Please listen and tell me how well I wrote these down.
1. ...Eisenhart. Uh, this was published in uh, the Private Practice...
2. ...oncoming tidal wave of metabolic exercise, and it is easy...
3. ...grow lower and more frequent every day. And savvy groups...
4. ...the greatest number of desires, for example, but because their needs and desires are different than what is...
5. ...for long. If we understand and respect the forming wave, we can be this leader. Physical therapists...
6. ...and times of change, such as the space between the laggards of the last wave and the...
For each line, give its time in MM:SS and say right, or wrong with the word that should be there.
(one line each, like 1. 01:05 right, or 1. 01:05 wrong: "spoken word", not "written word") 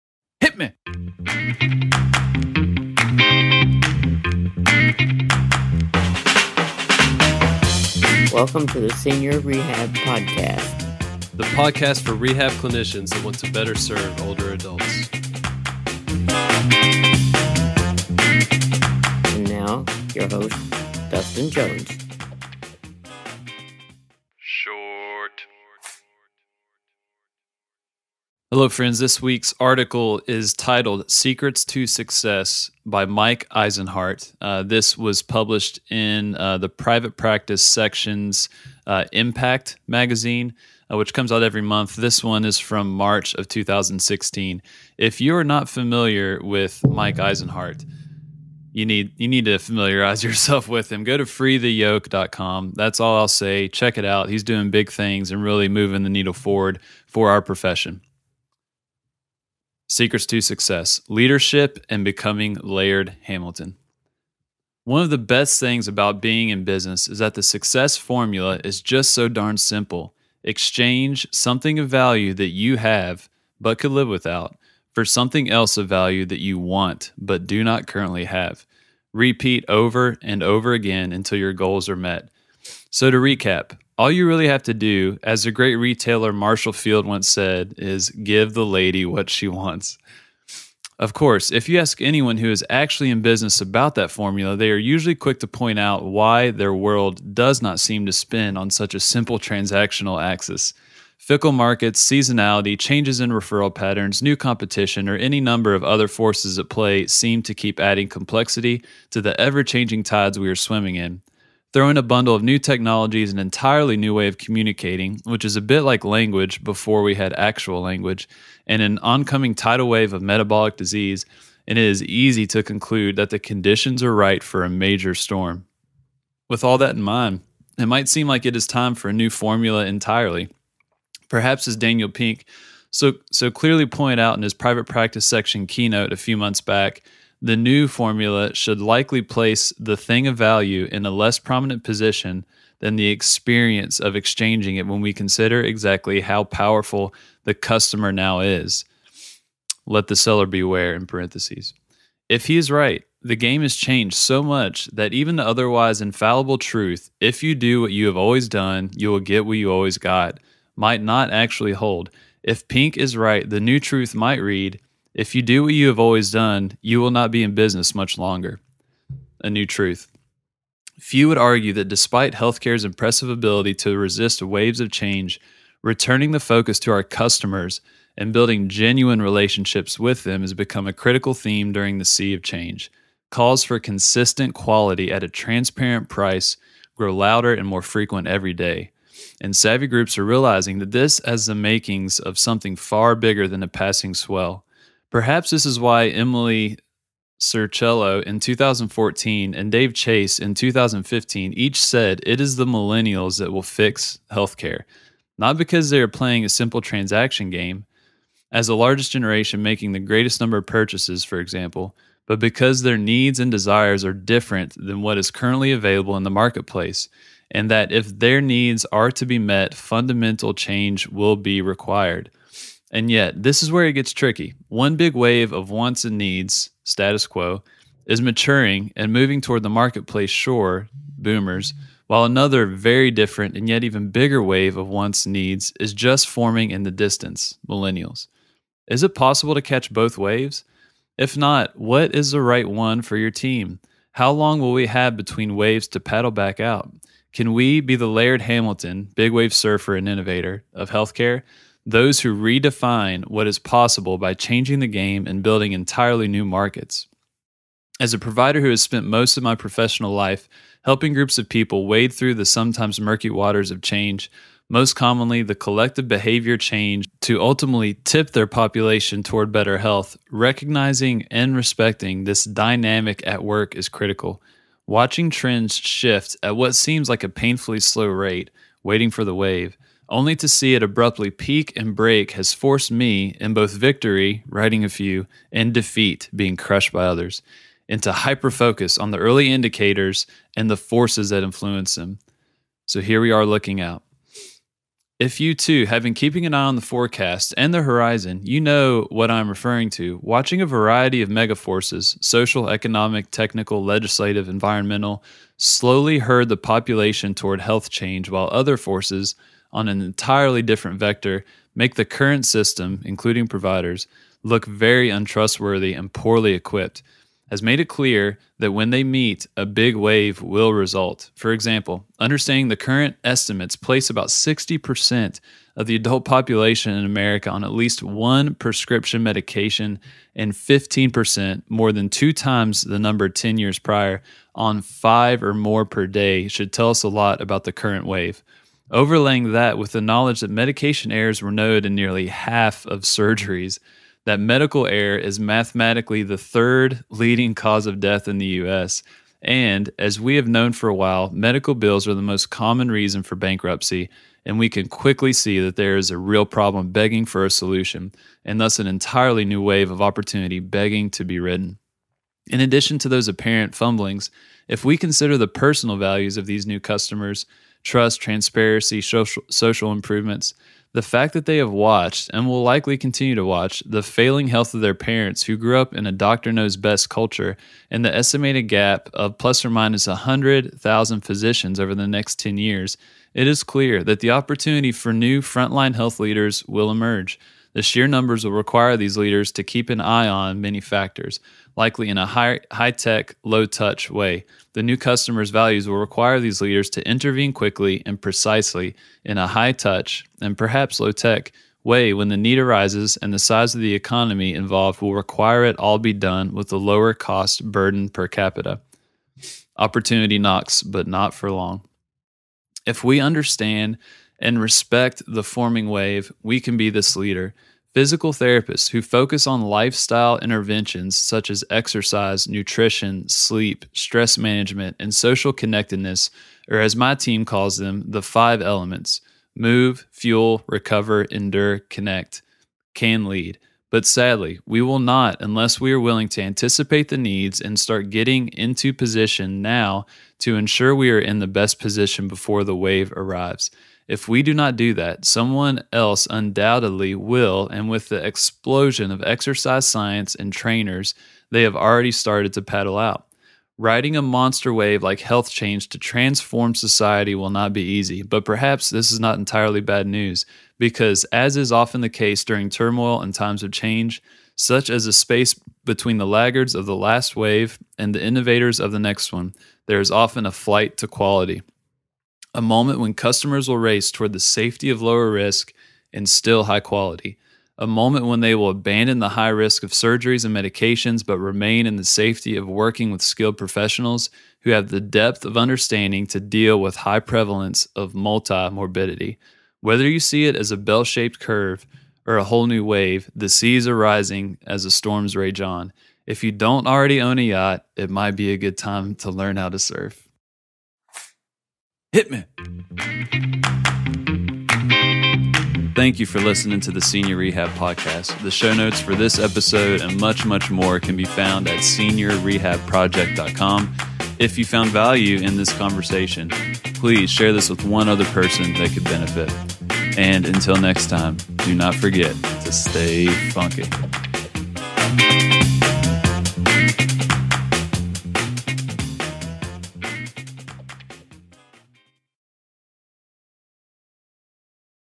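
1. 00:33 right
2. 01:58 wrong: "disease", not "exercise"
3. 03:06 wrong: "louder", not "lower"
4. 03:29 wrong: "purchases", not "desires"
5. 06:51 right
6. 07:43 right.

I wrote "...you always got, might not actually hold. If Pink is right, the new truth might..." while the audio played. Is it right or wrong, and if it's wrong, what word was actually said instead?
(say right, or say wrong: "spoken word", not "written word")
right.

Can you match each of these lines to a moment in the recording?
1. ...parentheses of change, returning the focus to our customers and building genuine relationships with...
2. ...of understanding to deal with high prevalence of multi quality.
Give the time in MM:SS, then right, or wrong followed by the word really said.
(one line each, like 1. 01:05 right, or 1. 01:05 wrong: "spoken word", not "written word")
1. 02:54 wrong: "waves", not "parentheses"
2. 08:05 wrong: "morbidity", not "quality".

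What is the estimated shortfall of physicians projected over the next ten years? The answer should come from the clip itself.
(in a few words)
100,000.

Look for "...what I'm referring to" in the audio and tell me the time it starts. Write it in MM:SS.
04:59.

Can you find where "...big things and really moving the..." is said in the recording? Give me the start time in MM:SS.
00:54.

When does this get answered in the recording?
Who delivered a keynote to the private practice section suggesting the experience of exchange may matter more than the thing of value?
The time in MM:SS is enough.
02:11.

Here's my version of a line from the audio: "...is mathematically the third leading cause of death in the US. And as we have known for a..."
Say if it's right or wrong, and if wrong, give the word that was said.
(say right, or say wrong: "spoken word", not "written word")
right.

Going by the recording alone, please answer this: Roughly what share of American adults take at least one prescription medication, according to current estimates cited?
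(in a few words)
60%.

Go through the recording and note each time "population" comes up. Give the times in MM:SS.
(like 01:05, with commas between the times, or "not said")
04:28, 05:06, 05:26.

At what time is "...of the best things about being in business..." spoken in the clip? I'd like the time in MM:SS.
01:05.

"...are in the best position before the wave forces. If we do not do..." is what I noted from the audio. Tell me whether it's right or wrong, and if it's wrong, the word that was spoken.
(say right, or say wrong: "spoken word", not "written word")
wrong: "arrives", not "forces".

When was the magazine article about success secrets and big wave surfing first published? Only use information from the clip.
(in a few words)
March 2016.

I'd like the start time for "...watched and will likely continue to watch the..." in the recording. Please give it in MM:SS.
06:11.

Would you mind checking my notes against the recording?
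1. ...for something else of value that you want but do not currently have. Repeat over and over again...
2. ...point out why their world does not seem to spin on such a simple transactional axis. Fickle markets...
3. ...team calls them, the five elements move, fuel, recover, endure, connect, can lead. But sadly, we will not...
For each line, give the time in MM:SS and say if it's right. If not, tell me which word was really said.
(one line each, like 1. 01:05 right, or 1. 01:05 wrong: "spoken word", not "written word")
1. 01:14 right
2. 01:35 right
3. 07:07 right.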